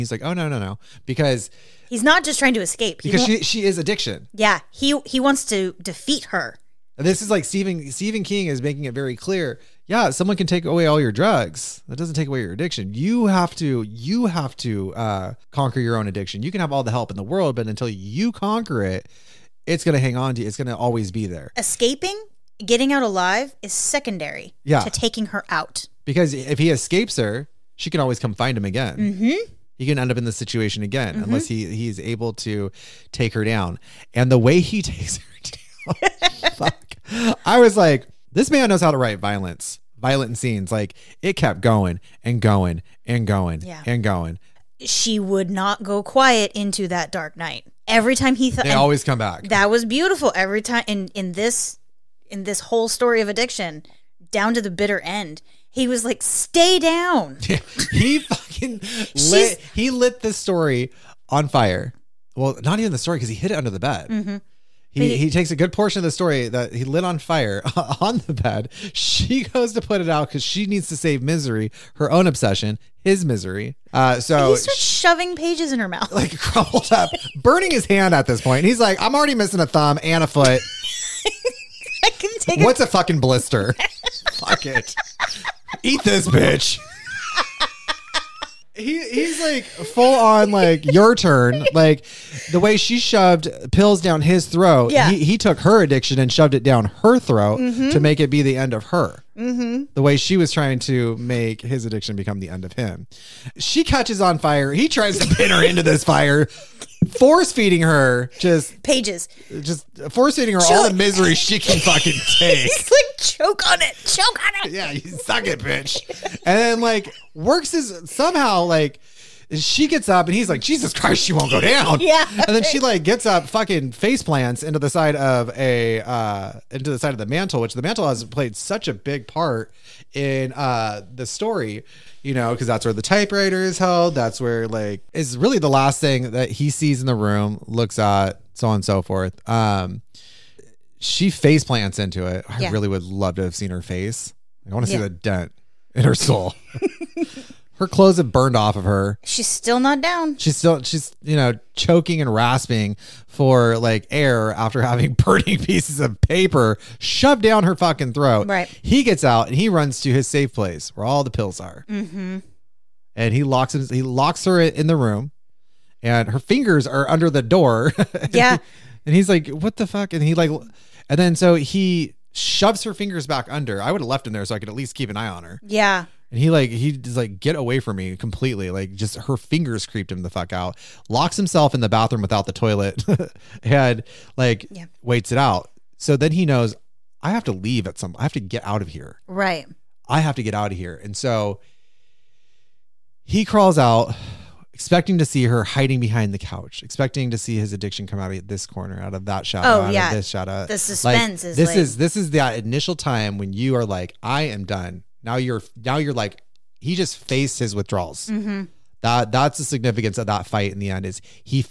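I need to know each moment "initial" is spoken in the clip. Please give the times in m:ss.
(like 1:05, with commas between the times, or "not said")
3:22.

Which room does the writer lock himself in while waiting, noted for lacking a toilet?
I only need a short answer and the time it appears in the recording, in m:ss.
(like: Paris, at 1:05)
Bathroom, at 3:01.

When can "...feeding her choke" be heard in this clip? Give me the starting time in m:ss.
1:50.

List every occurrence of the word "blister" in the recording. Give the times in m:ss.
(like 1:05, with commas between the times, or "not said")
1:23.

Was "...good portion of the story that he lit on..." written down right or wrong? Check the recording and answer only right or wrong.
right.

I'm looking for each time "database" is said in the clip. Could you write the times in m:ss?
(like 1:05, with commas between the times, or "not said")
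not said.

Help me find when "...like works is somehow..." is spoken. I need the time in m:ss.
1:56.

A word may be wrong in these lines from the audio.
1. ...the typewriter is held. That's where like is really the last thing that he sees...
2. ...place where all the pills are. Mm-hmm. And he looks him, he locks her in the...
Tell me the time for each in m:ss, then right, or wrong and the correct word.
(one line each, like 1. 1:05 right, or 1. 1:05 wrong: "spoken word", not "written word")
1. 2:12 right
2. 2:40 wrong: "locks", not "looks".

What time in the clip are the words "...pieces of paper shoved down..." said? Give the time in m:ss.
2:35.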